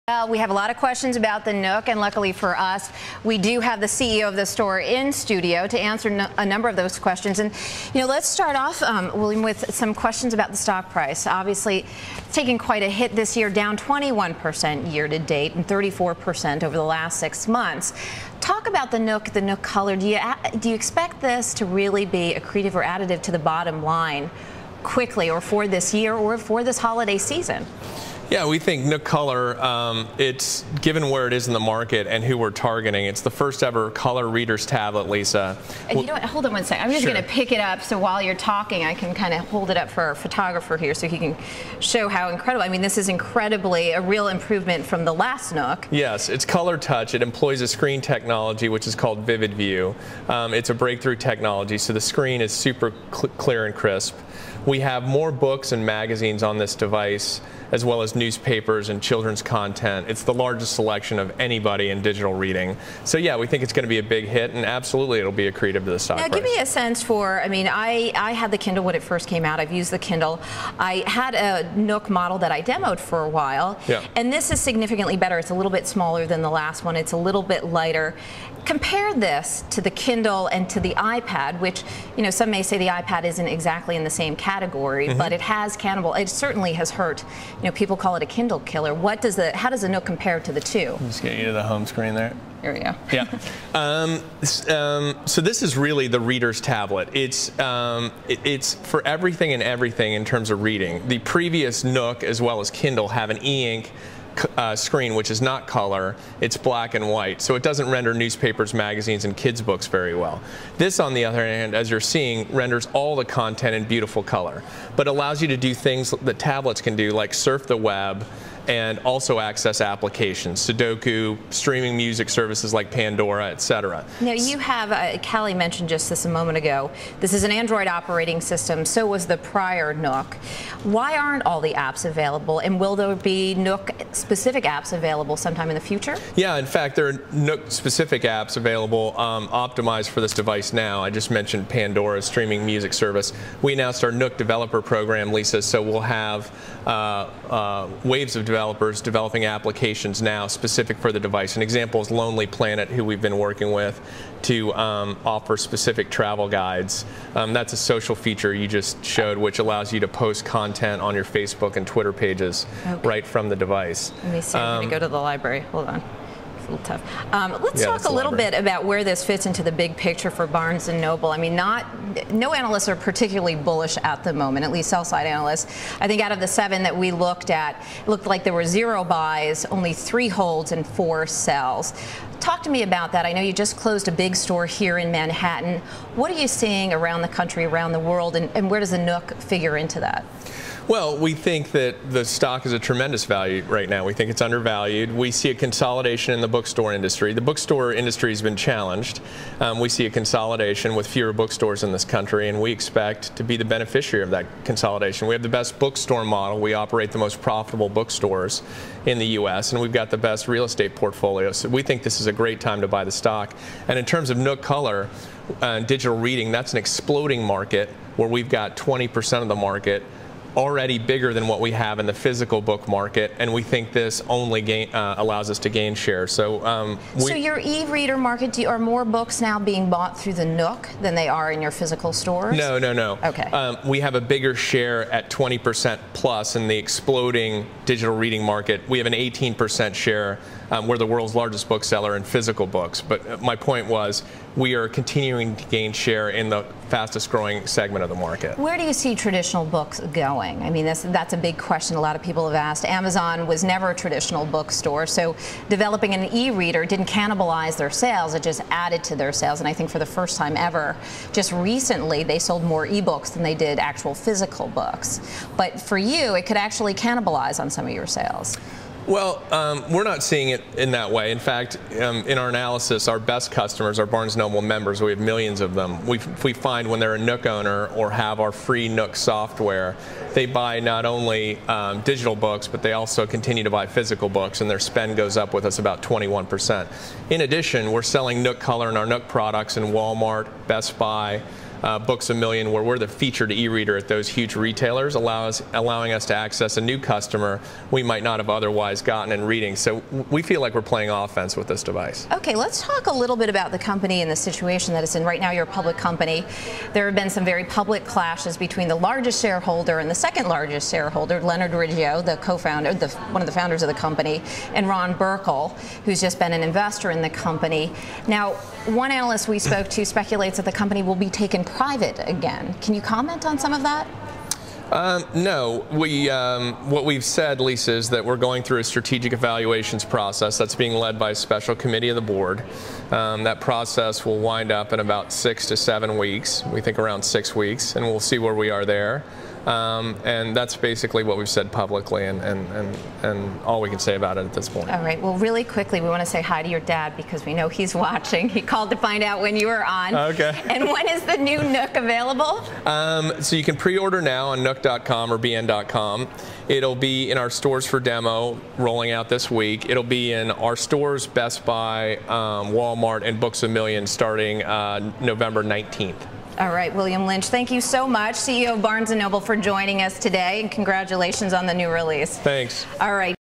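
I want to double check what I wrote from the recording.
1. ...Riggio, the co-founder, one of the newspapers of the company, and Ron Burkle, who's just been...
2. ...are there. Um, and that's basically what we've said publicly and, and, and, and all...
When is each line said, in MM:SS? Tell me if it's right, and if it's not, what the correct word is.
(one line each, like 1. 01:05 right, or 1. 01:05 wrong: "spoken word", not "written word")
1. 05:11 wrong: "founders", not "newspapers"
2. 05:38 right.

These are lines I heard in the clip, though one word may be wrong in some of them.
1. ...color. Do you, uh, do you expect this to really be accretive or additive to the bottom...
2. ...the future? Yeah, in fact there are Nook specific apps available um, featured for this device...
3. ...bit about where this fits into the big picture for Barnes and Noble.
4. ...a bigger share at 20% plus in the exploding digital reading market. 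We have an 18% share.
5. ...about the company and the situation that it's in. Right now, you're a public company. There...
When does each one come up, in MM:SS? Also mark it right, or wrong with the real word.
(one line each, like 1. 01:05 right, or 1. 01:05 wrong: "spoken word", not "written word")
1. 00:19 right
2. 02:15 wrong: "optimized", not "featured"
3. 02:48 right
4. 03:54 right
5. 05:03 right.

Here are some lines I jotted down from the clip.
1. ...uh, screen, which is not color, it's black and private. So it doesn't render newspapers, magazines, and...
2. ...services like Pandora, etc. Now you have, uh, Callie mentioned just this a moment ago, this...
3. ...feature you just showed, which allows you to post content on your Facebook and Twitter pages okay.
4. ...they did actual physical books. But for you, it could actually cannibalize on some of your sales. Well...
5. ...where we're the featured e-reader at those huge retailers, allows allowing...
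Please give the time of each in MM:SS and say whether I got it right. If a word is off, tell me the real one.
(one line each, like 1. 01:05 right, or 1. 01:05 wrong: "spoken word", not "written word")
1. 01:44 wrong: "white", not "private"
2. 02:02 right
3. 02:38 right
4. 04:23 right
5. 04:52 right.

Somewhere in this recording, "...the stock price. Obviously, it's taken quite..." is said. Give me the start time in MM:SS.
00:10.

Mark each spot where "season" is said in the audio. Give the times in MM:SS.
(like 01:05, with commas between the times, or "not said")
00:27.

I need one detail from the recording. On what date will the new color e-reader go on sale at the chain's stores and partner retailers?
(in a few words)
November 19th.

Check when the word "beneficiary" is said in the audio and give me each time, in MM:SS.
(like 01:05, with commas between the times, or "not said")
03:23.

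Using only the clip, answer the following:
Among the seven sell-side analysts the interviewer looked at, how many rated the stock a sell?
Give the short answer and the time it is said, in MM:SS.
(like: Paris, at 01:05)
4, at 03:00.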